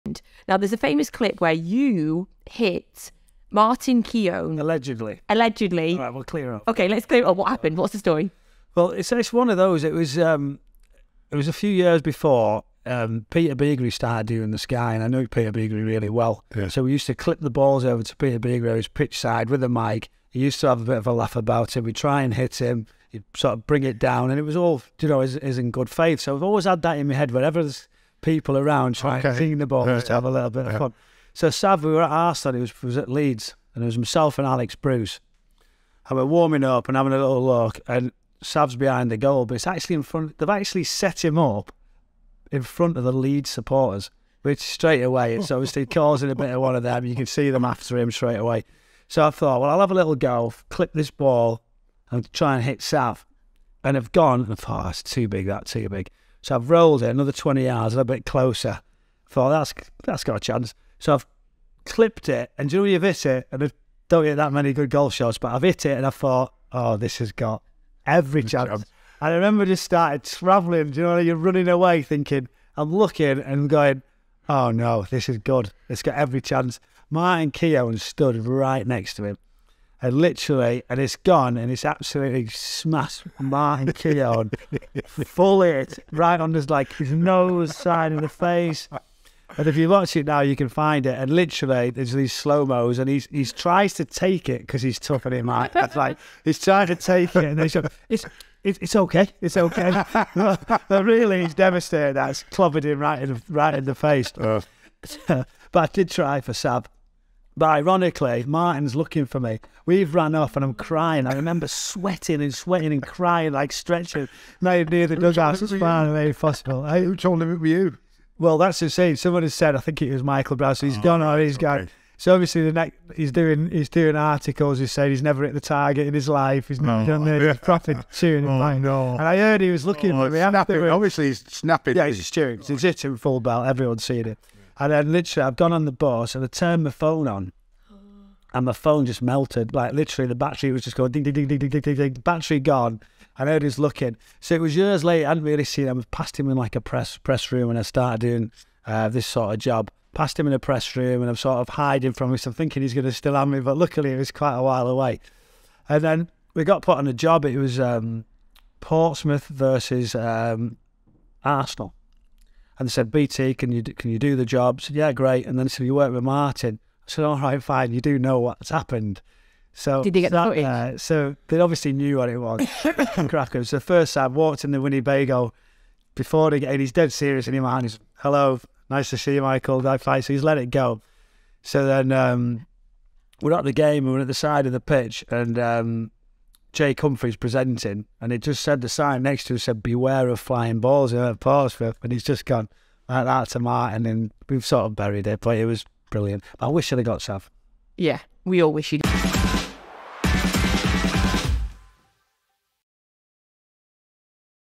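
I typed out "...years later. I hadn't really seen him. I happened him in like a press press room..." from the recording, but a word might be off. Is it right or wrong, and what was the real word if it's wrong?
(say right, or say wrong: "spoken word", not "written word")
wrong: "passed", not "happened".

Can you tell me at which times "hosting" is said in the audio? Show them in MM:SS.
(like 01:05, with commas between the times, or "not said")
not said.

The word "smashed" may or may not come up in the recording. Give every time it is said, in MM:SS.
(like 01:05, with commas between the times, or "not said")
01:22.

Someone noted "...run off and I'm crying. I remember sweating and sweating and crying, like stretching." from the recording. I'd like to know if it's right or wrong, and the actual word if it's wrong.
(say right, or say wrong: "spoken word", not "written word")
right.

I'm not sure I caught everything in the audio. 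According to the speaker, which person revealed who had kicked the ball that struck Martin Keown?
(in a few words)
Michael Brown.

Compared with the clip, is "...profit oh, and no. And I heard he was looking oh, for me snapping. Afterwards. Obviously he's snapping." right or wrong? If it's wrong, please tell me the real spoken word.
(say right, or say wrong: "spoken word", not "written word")
right.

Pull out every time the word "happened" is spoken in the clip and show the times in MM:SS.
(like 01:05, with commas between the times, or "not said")
00:07, 02:48.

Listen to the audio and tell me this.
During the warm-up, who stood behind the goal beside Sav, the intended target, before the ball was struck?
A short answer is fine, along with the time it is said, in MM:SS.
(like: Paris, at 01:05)
Alex Bruce, at 00:34.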